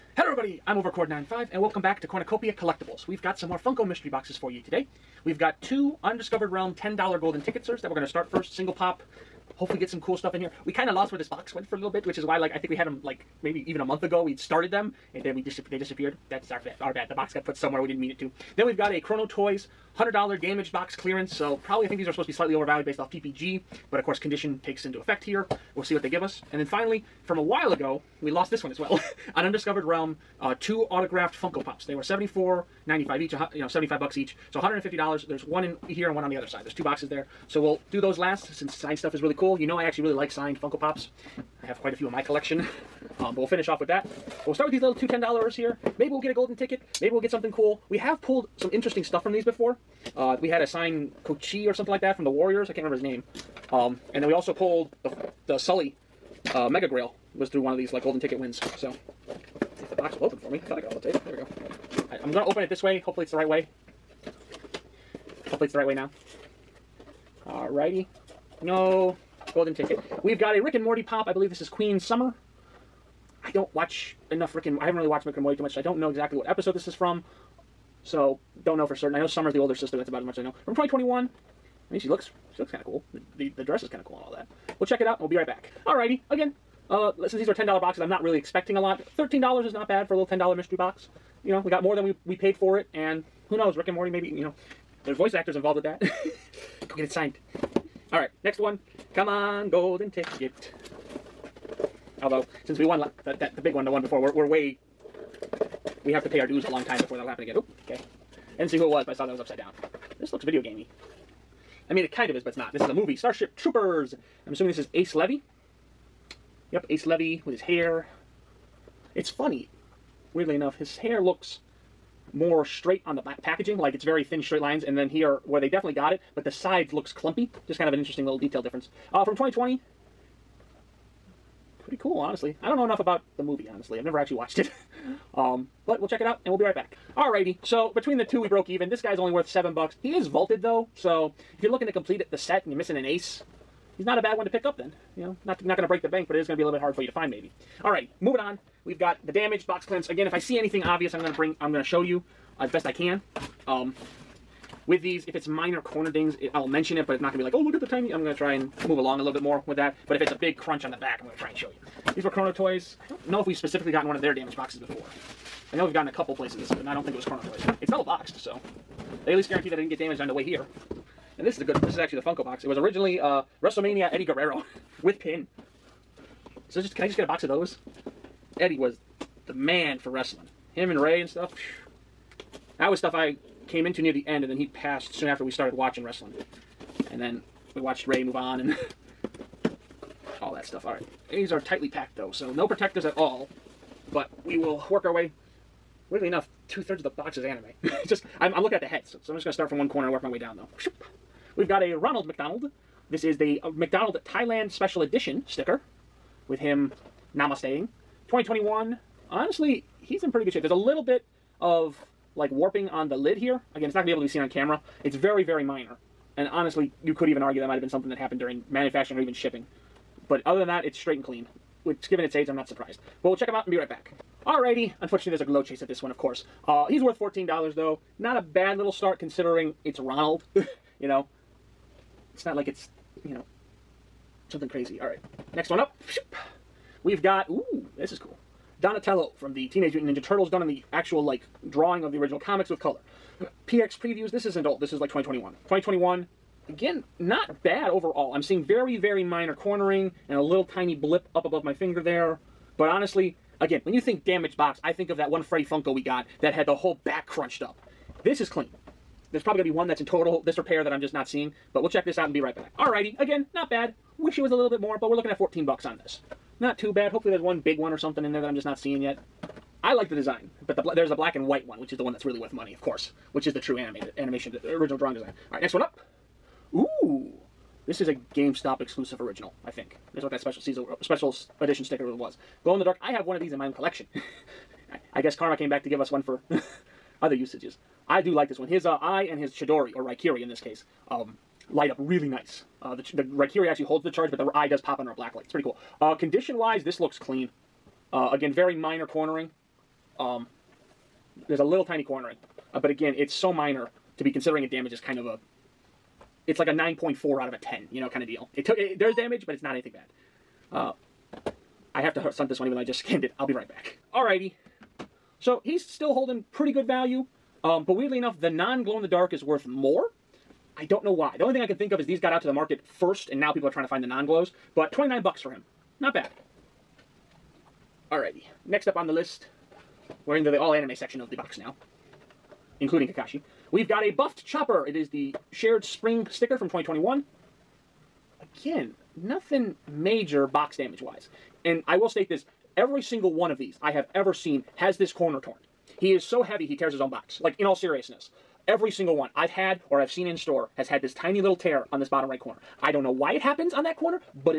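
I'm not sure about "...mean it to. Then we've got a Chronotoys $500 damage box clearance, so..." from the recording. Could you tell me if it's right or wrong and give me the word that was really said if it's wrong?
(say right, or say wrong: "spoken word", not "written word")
wrong: "100", not "500".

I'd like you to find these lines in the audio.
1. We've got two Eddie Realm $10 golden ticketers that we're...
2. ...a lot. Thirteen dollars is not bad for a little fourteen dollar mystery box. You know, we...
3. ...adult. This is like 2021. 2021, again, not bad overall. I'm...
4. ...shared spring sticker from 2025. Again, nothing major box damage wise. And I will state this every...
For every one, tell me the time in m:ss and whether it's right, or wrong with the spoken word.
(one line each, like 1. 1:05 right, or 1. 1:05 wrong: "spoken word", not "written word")
1. 0:05 wrong: "Undiscovered", not "Eddie"
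2. 1:28 wrong: "ten", not "fourteen"
3. 4:04 right
4. 5:35 wrong: "2021", not "2025".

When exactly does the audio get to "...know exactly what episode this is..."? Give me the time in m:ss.
1:15.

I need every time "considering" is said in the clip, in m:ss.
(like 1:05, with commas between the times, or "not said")
3:49, 5:04.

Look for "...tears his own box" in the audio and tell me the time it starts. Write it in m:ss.
5:46.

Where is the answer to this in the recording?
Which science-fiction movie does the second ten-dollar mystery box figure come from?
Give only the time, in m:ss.
1:53.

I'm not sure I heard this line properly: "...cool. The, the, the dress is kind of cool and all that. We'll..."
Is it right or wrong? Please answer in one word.
right.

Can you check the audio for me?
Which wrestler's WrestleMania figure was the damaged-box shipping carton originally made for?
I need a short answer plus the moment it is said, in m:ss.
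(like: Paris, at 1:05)
Eddie Guerrero, at 2:54.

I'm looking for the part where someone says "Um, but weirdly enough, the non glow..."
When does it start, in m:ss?
5:17.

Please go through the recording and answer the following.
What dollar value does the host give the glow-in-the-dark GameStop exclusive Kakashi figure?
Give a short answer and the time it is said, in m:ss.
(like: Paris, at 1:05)
$29, at 5:24.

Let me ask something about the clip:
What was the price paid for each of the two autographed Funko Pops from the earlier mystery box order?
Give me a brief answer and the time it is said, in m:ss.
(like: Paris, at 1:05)
$74.95, at 0:32.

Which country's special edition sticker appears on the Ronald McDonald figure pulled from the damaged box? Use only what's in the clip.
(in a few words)
Thailand.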